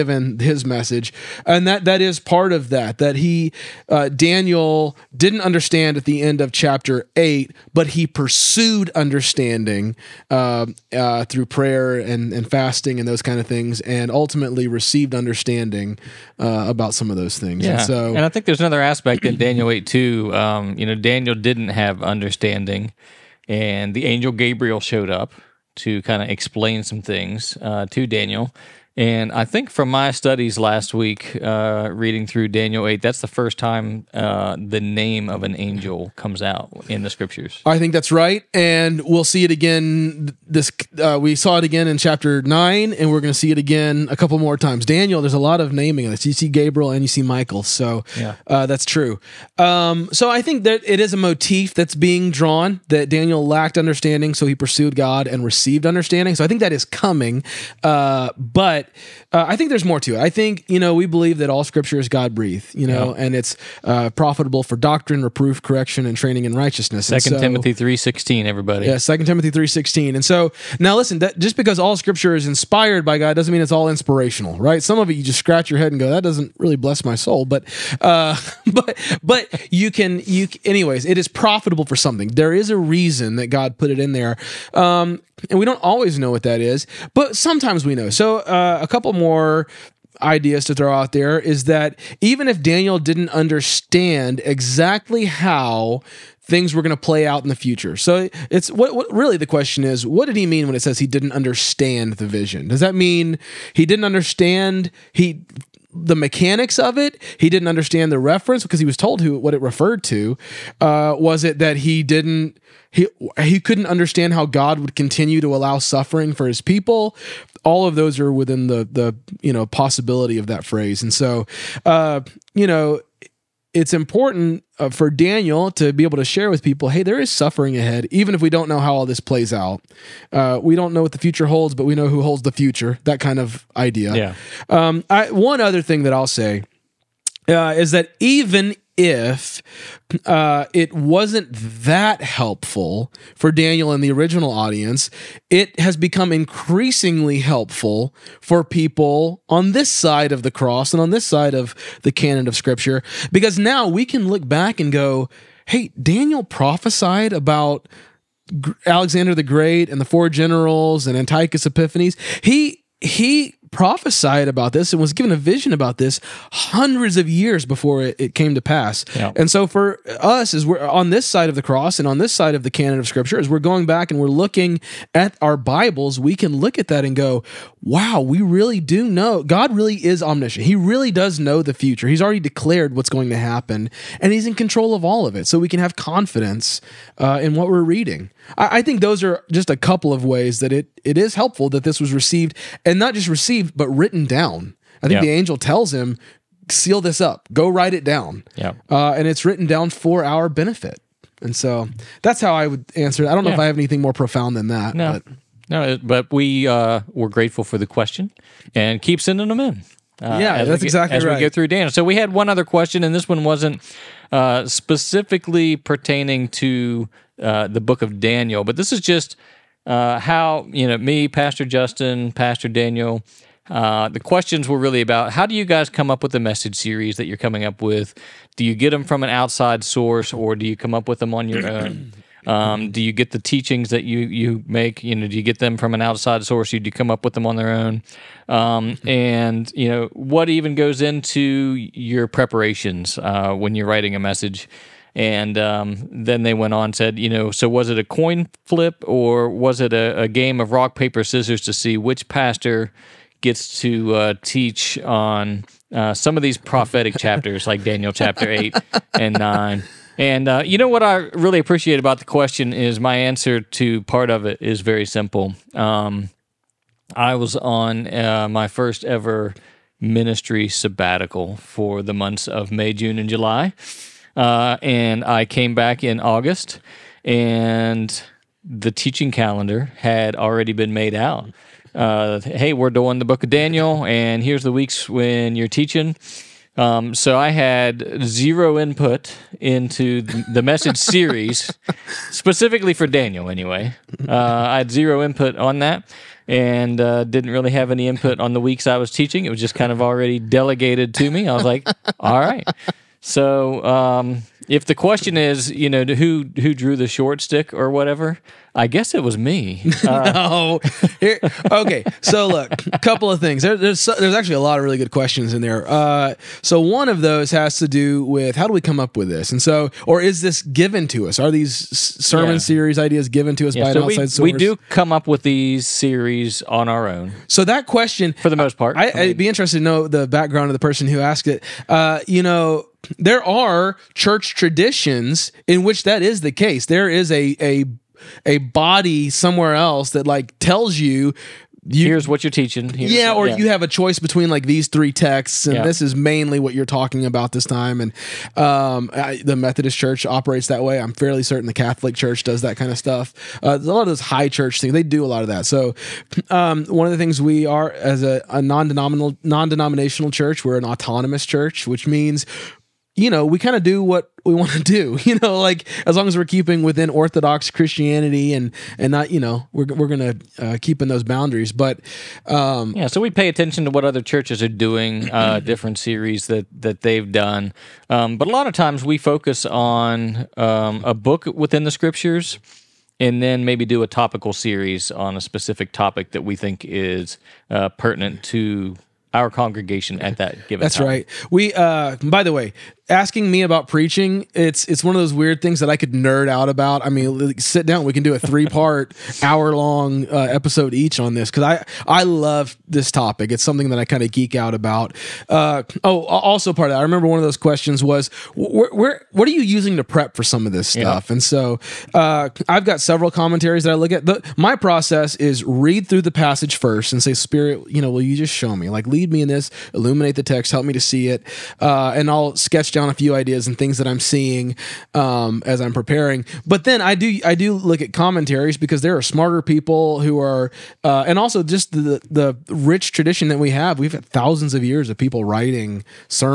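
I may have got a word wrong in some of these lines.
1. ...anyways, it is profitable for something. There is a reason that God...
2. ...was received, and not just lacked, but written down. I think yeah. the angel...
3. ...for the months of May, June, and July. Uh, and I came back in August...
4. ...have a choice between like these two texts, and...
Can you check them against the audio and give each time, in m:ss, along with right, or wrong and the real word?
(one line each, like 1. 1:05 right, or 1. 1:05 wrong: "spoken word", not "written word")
1. 1:20 right
2. 3:11 wrong: "received", not "lacked"
3. 4:31 right
4. 5:43 wrong: "three", not "two".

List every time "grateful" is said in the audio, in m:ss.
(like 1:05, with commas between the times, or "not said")
3:27.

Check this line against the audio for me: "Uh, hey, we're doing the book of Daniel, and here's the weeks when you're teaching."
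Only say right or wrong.
right.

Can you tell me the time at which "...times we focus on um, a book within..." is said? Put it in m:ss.
6:18.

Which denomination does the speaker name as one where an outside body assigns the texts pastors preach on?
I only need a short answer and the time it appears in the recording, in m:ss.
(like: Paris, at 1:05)
Methodist Church, at 5:49.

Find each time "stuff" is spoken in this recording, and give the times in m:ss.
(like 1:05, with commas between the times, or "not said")
5:52, 6:50.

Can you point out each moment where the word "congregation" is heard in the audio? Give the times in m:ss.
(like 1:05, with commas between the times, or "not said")
6:29.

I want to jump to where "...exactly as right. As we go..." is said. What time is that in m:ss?
3:30.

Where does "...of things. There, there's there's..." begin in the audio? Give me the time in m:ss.
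5:13.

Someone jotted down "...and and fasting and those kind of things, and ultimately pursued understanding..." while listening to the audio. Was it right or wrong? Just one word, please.
wrong.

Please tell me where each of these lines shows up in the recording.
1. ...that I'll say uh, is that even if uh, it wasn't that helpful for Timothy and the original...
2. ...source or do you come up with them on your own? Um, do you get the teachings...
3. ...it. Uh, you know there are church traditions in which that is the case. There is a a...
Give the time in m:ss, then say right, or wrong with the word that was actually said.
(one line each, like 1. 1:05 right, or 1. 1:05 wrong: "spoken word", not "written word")
1. 2:16 wrong: "Daniel", not "Timothy"
2. 3:49 right
3. 5:31 right.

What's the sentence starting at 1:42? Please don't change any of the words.
Does that mean he didn't understand he the mechanics of it.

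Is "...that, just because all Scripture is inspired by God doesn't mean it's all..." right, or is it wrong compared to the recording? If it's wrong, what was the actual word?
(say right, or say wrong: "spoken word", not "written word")
right.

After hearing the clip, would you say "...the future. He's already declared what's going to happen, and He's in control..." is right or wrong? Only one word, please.
right.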